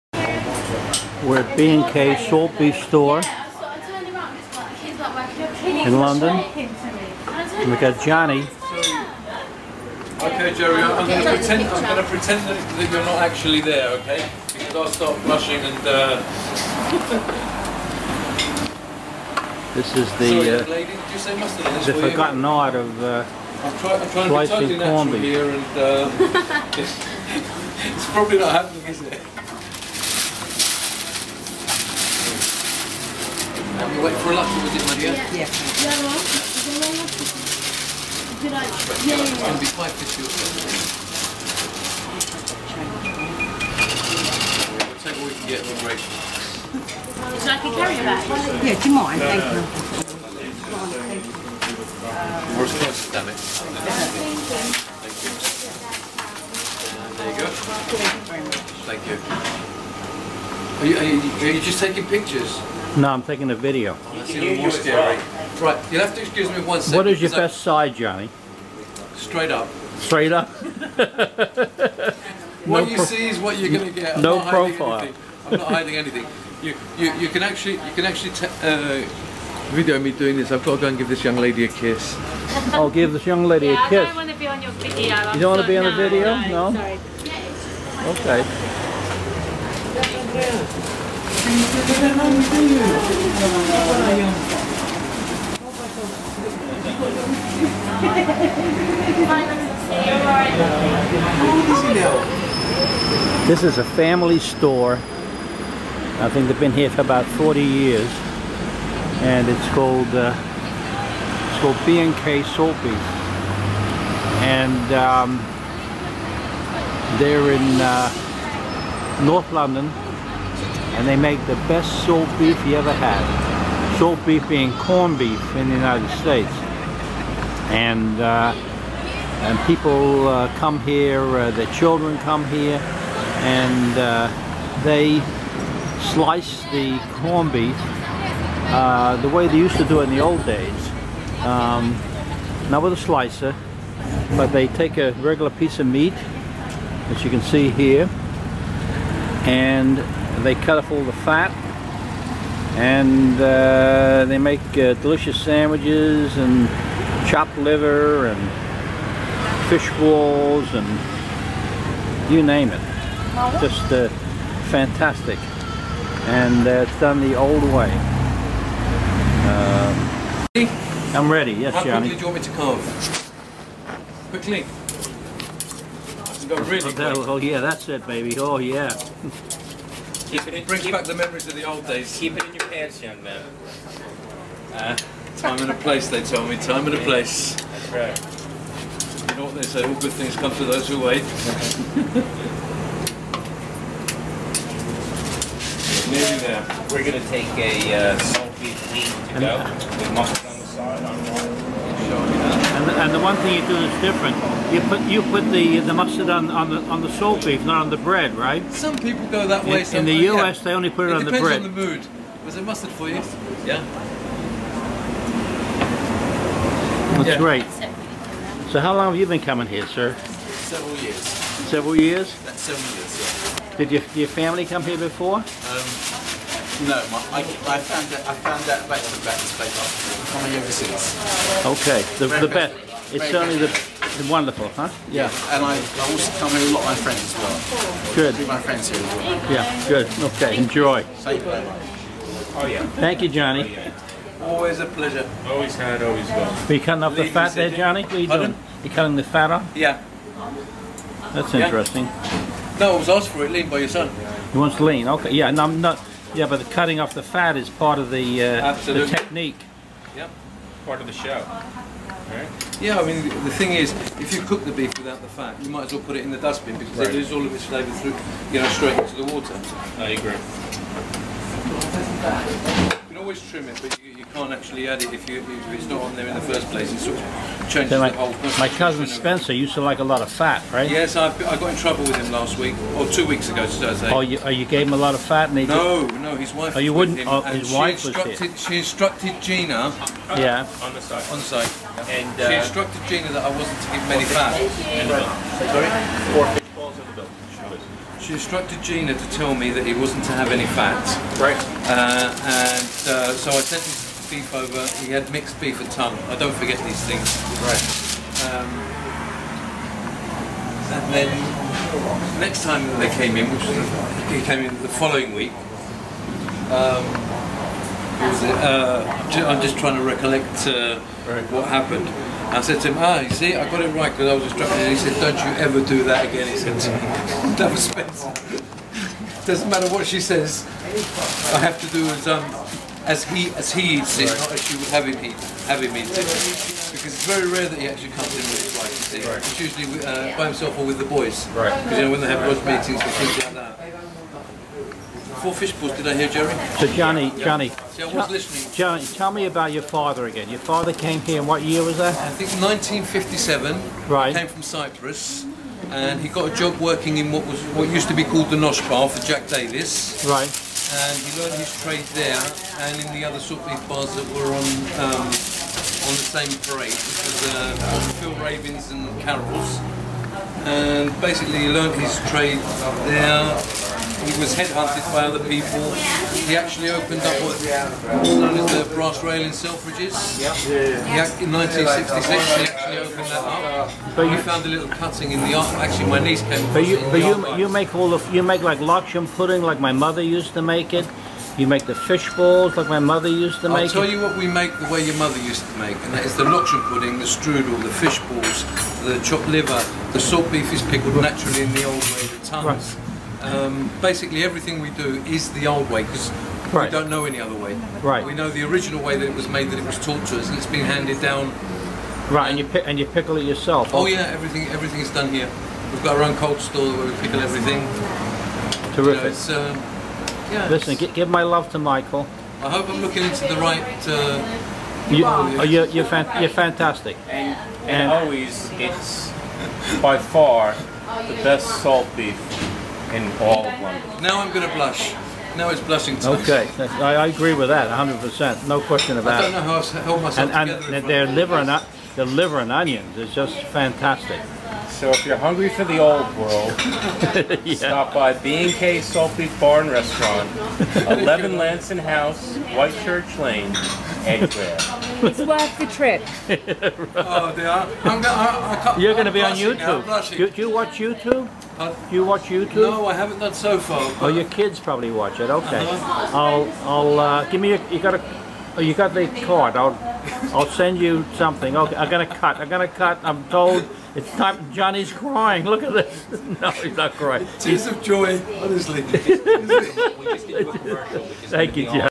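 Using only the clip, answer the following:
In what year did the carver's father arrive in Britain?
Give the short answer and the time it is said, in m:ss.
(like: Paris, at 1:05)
1957, at 5:52.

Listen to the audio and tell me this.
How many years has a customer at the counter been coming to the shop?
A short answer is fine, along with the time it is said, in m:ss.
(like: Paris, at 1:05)
7, at 3:42.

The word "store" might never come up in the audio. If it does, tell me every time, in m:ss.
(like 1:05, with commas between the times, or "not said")
0:02, 1:44, 6:56.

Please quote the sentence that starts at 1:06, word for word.
What is your best side, Johnny?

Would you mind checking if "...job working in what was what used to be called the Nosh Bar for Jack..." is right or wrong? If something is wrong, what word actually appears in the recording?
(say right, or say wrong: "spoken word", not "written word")
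right.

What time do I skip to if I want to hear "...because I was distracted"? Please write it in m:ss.
5:24.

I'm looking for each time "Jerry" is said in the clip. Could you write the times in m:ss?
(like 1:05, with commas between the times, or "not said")
0:10, 5:46.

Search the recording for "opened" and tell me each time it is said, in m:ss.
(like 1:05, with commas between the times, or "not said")
6:16, 6:22.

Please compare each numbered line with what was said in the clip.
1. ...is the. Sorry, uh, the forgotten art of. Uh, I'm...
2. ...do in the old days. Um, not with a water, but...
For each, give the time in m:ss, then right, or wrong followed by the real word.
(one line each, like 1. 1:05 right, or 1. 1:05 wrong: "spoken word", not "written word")
1. 0:19 right
2. 2:19 wrong: "slicer", not "water".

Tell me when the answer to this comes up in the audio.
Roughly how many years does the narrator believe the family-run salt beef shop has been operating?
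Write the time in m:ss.
1:47.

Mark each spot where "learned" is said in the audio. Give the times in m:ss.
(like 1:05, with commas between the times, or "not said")
6:01, 6:11.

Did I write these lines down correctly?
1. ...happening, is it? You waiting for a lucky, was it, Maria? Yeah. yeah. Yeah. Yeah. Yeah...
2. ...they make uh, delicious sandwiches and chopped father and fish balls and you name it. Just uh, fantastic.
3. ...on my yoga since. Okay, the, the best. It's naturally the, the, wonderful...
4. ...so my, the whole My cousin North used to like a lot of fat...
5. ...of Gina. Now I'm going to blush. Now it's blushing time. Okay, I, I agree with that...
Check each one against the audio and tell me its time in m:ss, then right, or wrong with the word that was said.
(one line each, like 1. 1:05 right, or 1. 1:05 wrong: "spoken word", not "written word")
1. 0:28 right
2. 2:34 wrong: "liver", not "father"
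3. 3:49 wrong: "certainly", not "naturally"
4. 4:37 wrong: "Spencer", not "North"
5. 7:13 wrong: "London", not "Gina".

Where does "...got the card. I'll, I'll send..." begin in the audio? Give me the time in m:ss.
7:48.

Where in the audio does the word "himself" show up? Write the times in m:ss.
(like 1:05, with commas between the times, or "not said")
5:40.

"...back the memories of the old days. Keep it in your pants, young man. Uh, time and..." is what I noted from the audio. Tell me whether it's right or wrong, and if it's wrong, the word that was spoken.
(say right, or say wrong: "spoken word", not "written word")
right.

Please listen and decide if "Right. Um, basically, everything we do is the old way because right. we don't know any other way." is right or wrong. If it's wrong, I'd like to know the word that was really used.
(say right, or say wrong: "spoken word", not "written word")
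right.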